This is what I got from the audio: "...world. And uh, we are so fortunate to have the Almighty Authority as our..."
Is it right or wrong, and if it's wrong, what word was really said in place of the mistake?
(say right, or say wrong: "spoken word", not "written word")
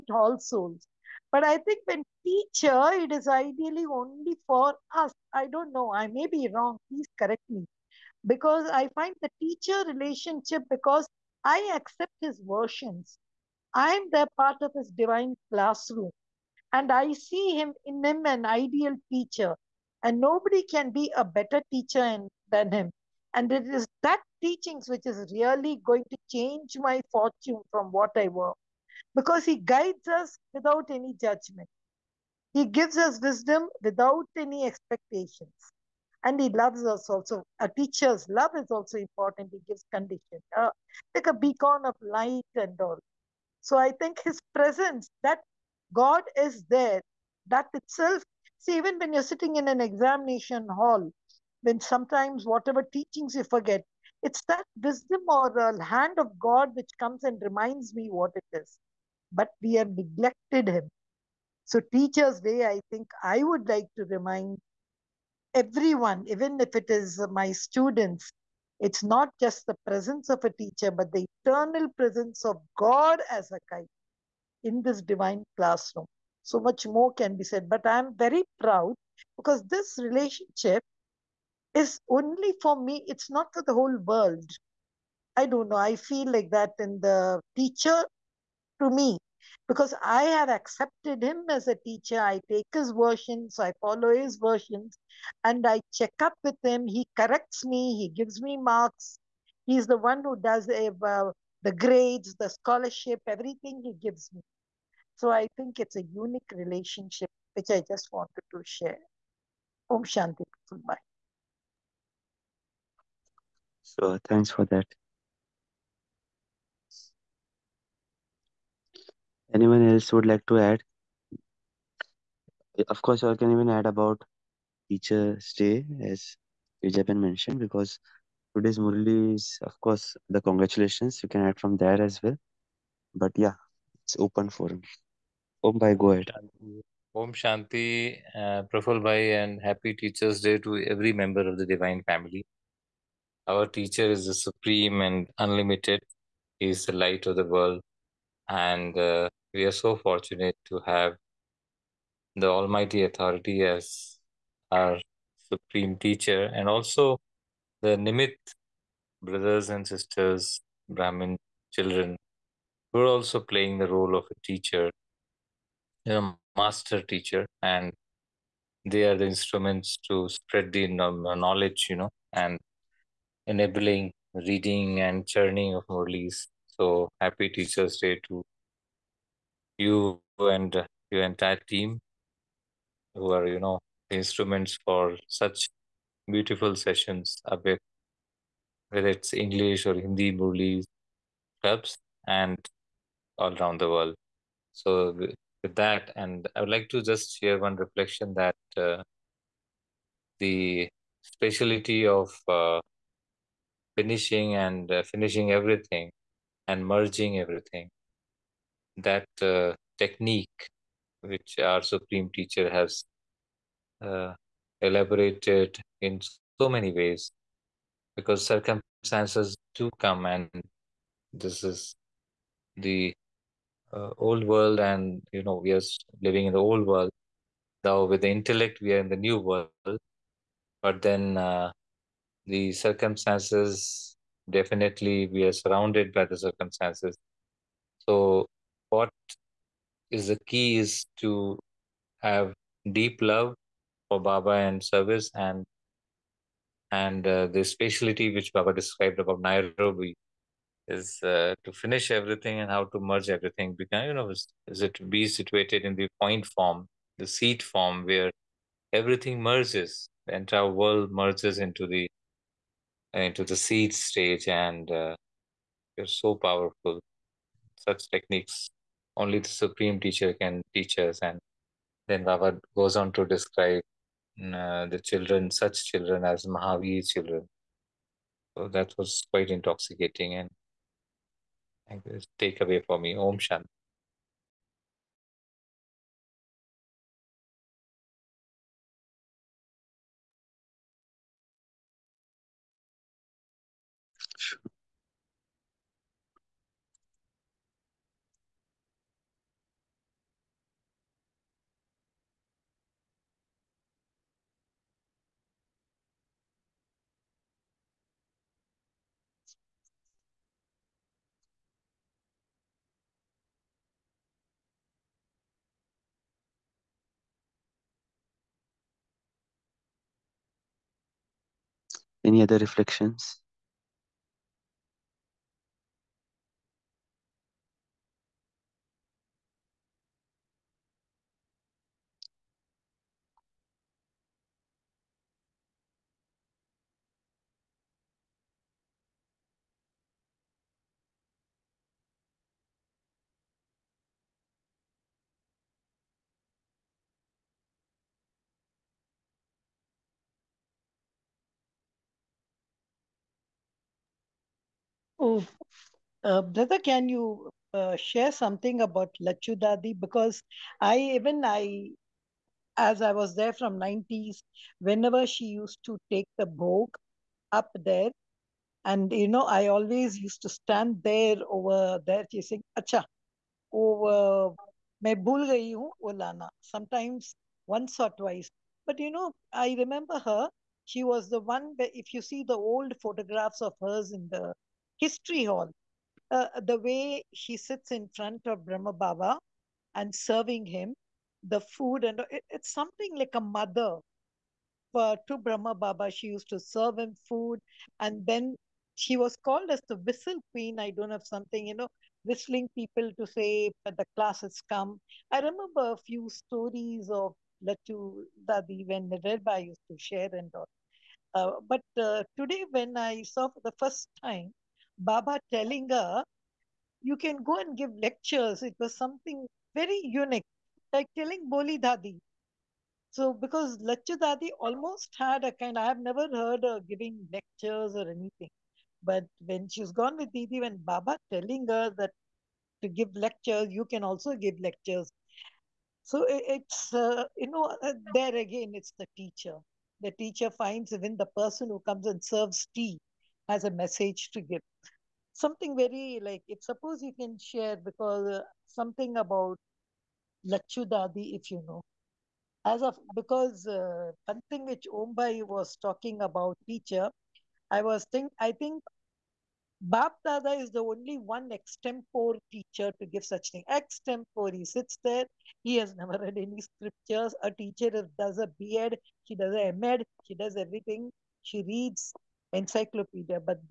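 right.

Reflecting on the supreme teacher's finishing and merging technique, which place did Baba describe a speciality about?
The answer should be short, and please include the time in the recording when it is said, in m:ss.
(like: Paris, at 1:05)
Nairobi, at 4:09.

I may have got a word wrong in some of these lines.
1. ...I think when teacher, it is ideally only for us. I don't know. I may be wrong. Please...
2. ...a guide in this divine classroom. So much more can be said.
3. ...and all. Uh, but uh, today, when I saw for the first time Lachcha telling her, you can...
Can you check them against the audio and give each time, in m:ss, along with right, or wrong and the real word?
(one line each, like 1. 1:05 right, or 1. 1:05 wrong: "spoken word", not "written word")
1. 0:01 right
2. 1:13 right
3. 6:50 wrong: "Baba", not "Lachcha".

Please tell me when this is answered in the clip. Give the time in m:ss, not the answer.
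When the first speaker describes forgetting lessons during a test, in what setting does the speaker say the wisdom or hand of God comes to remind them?
0:49.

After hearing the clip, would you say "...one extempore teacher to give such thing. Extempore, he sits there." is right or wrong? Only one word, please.
right.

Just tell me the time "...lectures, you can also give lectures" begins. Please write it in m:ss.
7:13.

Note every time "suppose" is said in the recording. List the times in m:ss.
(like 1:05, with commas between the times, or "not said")
7:26.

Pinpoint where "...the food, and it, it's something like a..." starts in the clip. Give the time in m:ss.
6:31.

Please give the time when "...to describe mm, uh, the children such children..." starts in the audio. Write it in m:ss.
4:33.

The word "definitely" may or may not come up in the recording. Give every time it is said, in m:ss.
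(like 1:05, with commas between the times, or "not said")
3:54.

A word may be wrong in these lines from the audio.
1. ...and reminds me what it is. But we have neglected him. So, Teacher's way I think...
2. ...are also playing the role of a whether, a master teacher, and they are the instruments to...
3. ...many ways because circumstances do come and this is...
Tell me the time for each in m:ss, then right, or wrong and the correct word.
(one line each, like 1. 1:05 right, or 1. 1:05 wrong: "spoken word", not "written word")
1. 0:57 right
2. 2:42 wrong: "teacher", not "whether"
3. 3:36 right.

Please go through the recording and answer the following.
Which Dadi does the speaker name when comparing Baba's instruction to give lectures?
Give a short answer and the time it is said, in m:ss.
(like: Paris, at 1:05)
Bholi Dadi, at 7:01.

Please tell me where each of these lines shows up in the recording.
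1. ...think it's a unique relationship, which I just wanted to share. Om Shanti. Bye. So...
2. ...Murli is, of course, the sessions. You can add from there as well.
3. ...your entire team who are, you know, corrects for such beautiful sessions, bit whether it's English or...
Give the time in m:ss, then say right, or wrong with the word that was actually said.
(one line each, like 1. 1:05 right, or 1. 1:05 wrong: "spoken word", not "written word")
1. 1:45 right
2. 2:08 wrong: "congratulations", not "sessions"
3. 3:01 wrong: "instruments", not "corrects".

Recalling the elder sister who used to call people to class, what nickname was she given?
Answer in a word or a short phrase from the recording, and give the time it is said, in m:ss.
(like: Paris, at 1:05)
the whistle queen, at 6:39.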